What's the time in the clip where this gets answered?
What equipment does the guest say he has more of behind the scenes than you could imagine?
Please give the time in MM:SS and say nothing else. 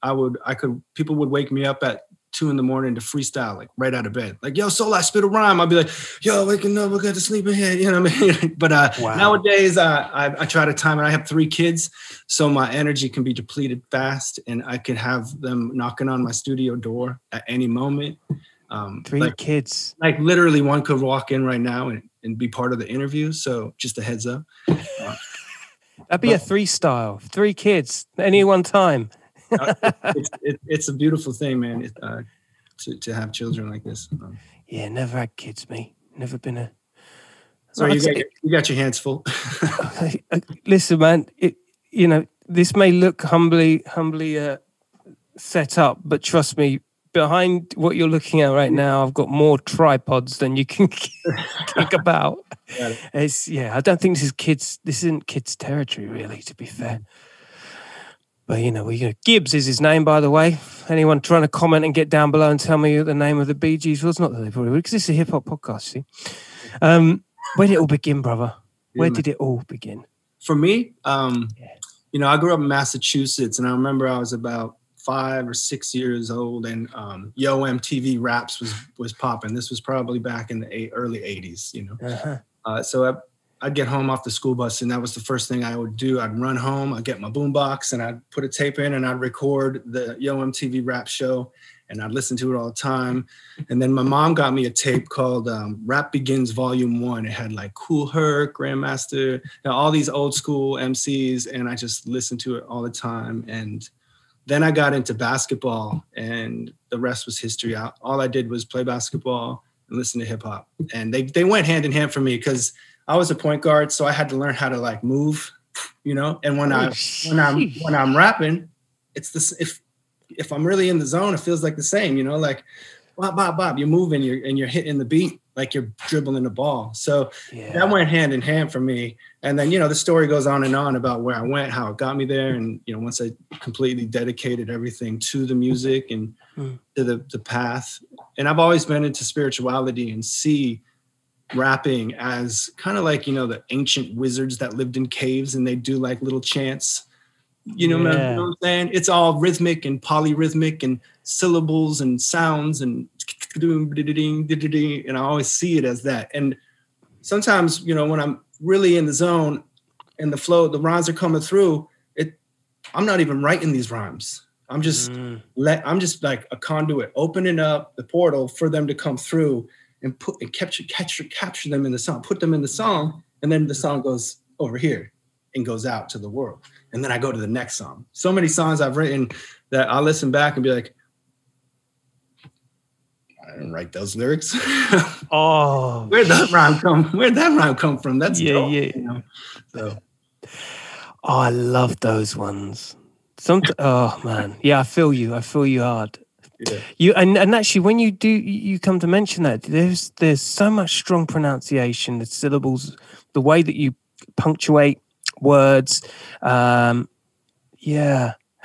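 00:49.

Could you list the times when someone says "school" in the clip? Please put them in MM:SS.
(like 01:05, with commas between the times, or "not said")
01:24, 01:40.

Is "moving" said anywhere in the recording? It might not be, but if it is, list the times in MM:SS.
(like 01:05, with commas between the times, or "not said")
02:03.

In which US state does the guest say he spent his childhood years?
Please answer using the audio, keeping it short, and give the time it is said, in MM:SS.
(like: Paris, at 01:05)
Massachusetts, at 01:12.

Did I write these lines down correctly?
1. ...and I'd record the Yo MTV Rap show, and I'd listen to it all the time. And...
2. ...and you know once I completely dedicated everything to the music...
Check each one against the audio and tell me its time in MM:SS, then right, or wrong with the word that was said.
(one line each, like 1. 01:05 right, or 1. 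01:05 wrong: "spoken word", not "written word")
1. 01:28 right
2. 02:12 right.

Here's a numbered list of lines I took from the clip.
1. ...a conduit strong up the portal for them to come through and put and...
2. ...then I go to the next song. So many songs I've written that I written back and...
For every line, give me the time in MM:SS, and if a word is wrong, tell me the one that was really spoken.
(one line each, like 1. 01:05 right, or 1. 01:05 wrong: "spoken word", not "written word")
1. 02:46 wrong: "opening", not "strong"
2. 02:57 wrong: "listen", not "written".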